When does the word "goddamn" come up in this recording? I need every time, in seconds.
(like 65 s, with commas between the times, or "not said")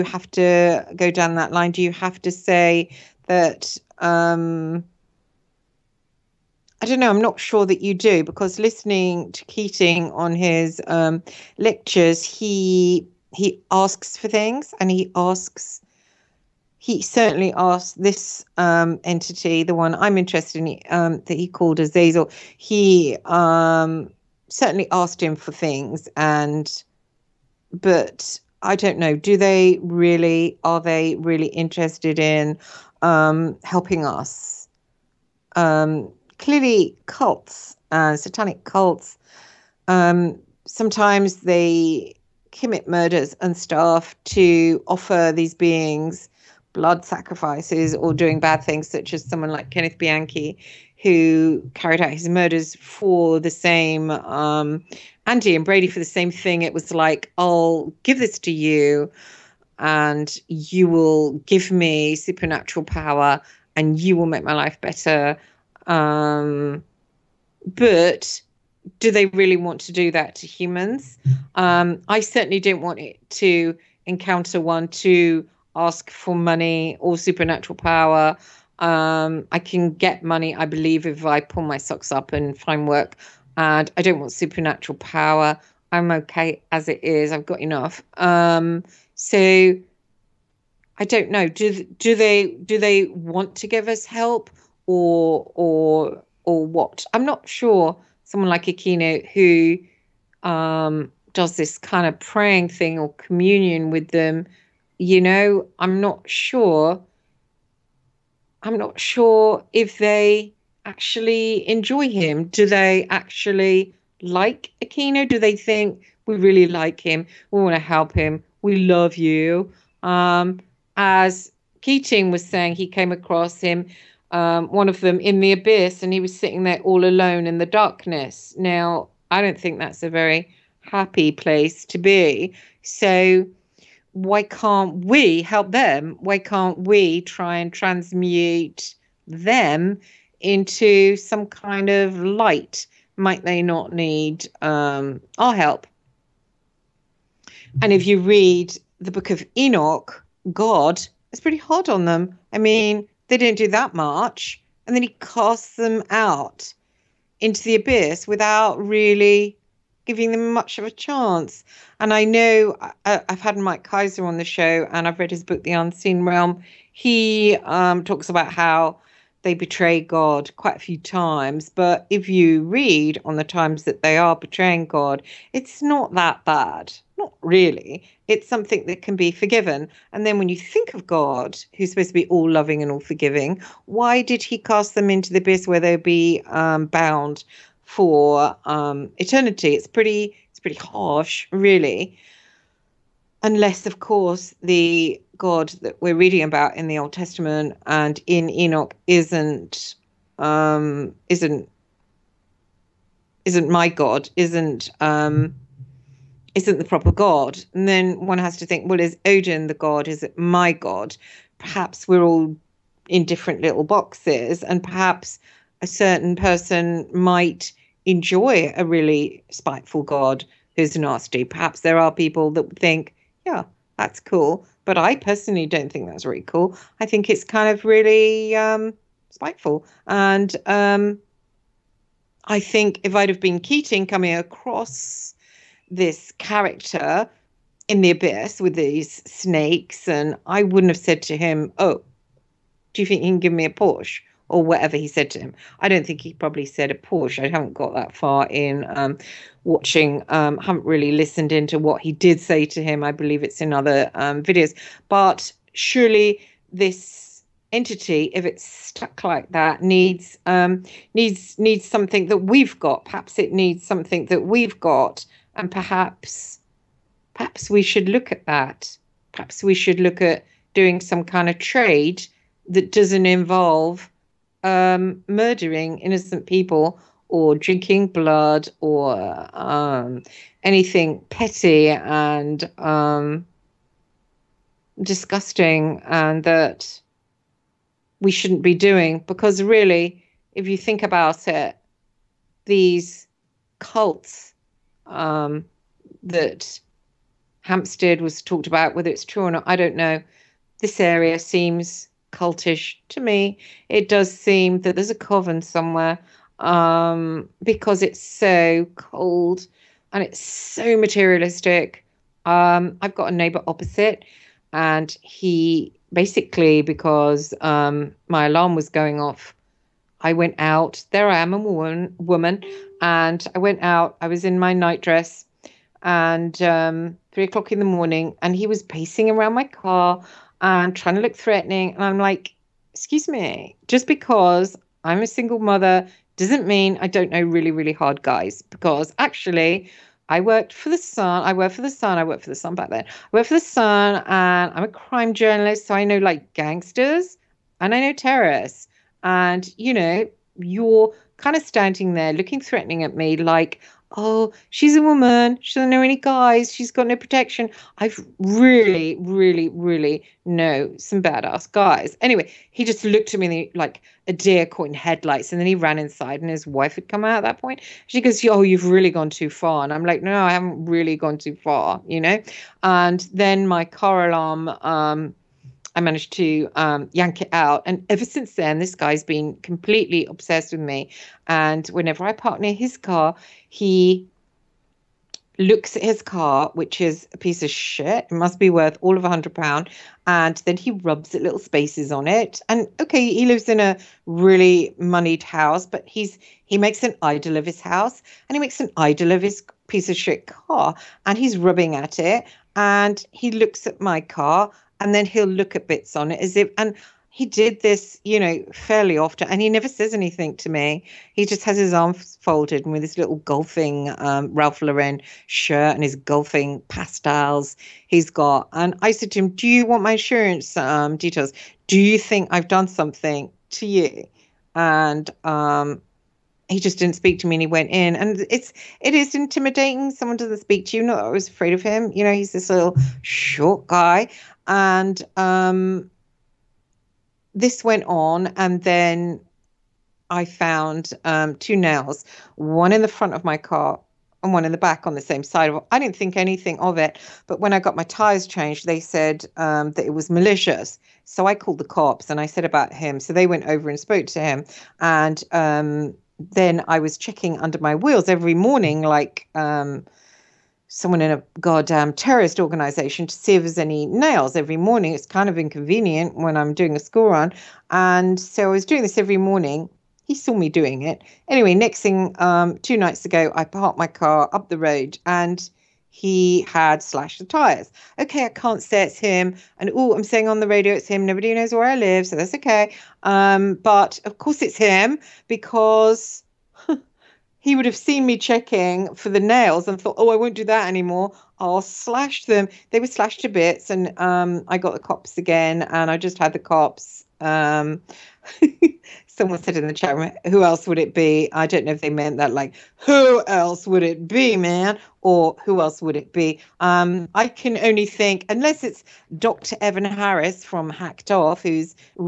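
461 s.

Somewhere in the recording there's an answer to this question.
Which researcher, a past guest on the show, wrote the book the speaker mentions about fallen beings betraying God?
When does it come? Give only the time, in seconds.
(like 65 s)
163 s.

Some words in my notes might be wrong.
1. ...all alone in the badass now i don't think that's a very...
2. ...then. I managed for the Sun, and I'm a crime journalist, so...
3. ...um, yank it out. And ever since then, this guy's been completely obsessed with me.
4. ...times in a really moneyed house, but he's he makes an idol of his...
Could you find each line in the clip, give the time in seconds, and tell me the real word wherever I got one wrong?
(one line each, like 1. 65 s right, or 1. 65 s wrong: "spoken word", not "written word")
1. 126 s wrong: "darkness", not "badass"
2. 342 s wrong: "worked", not "managed"
3. 376 s right
4. 393 s wrong: "lives", not "times".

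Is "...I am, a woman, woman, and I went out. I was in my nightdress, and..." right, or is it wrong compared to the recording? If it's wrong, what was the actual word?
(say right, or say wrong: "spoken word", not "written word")
right.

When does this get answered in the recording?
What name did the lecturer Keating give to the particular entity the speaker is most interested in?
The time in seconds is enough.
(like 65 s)
21 s.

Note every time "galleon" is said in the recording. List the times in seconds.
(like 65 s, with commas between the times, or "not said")
not said.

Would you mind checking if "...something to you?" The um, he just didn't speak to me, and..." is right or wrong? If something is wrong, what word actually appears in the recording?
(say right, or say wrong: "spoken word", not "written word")
wrong: "And", not "The".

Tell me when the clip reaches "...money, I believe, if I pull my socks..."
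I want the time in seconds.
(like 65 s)
80 s.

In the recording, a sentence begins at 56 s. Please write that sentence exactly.
It was like, I'll give this to you, and you will give me supernatural power, and you will make my life better.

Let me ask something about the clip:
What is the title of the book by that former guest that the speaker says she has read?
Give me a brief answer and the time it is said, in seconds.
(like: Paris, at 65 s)
The Unseen Realm, at 165 s.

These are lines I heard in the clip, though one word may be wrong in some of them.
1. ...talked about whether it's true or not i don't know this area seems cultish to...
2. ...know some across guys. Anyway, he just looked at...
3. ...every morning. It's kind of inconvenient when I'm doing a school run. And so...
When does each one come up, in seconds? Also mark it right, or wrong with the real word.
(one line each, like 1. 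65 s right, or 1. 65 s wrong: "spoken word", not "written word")
1. 298 s right
2. 360 s wrong: "badass", not "across"
3. 464 s right.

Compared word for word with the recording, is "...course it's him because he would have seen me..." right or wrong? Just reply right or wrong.
right.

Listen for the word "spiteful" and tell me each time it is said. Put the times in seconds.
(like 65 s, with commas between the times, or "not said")
219 s, 229 s.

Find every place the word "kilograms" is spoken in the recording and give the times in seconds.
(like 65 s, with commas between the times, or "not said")
not said.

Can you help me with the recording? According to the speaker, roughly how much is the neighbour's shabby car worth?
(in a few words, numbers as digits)
£100.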